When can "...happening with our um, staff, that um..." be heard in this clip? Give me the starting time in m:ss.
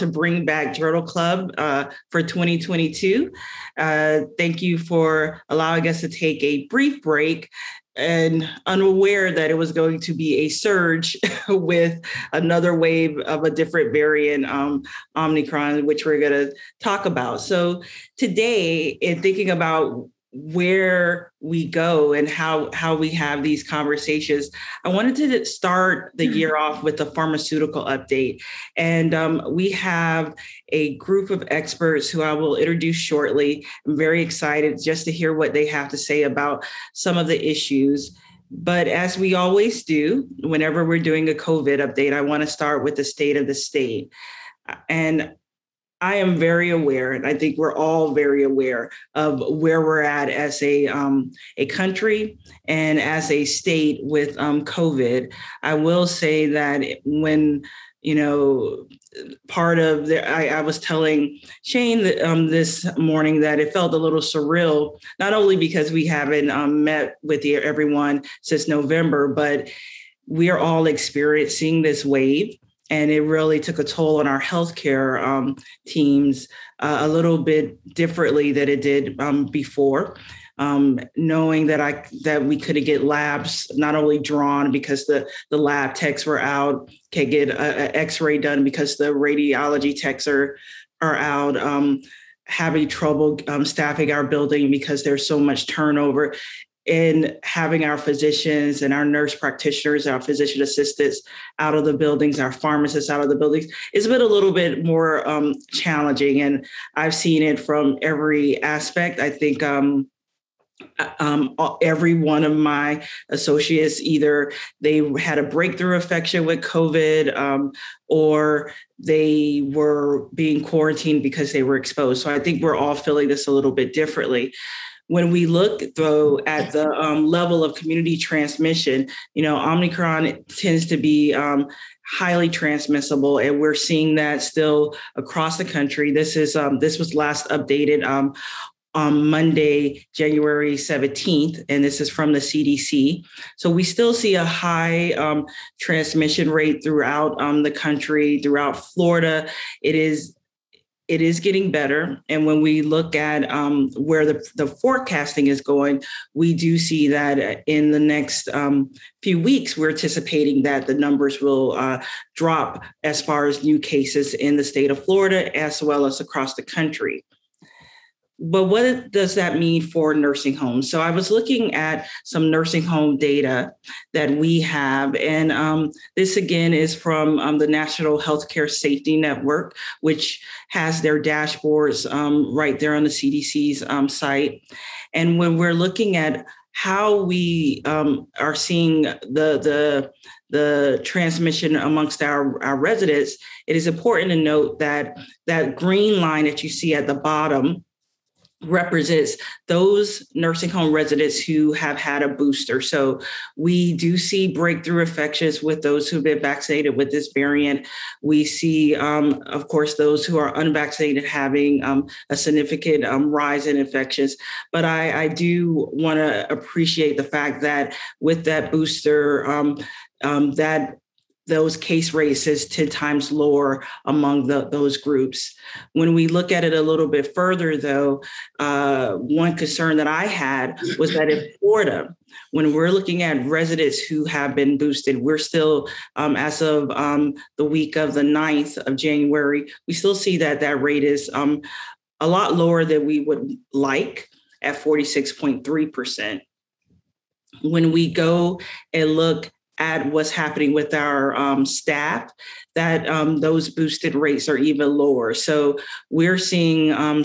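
4:10.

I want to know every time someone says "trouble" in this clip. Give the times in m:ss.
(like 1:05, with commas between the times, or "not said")
1:32.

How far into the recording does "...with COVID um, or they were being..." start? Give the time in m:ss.
1:56.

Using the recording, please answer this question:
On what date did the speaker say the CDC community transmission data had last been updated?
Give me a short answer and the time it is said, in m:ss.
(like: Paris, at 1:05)
Monday, January 17th, at 2:19.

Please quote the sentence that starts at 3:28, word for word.
We see, um, of course, those who are unvaccinated having um, a significant um, rise in infections.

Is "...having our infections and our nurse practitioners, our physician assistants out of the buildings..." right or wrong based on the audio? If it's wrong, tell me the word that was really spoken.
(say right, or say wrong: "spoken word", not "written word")
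wrong: "physicians", not "infections".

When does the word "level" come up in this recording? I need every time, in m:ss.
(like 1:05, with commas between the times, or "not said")
2:07.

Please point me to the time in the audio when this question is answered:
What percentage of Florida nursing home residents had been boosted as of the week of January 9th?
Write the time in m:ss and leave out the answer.
4:04.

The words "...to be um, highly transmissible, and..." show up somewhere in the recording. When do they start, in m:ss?
2:10.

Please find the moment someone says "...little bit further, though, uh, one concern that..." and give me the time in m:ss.
3:46.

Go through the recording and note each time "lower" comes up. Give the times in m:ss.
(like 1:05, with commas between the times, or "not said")
3:43, 4:02, 4:14.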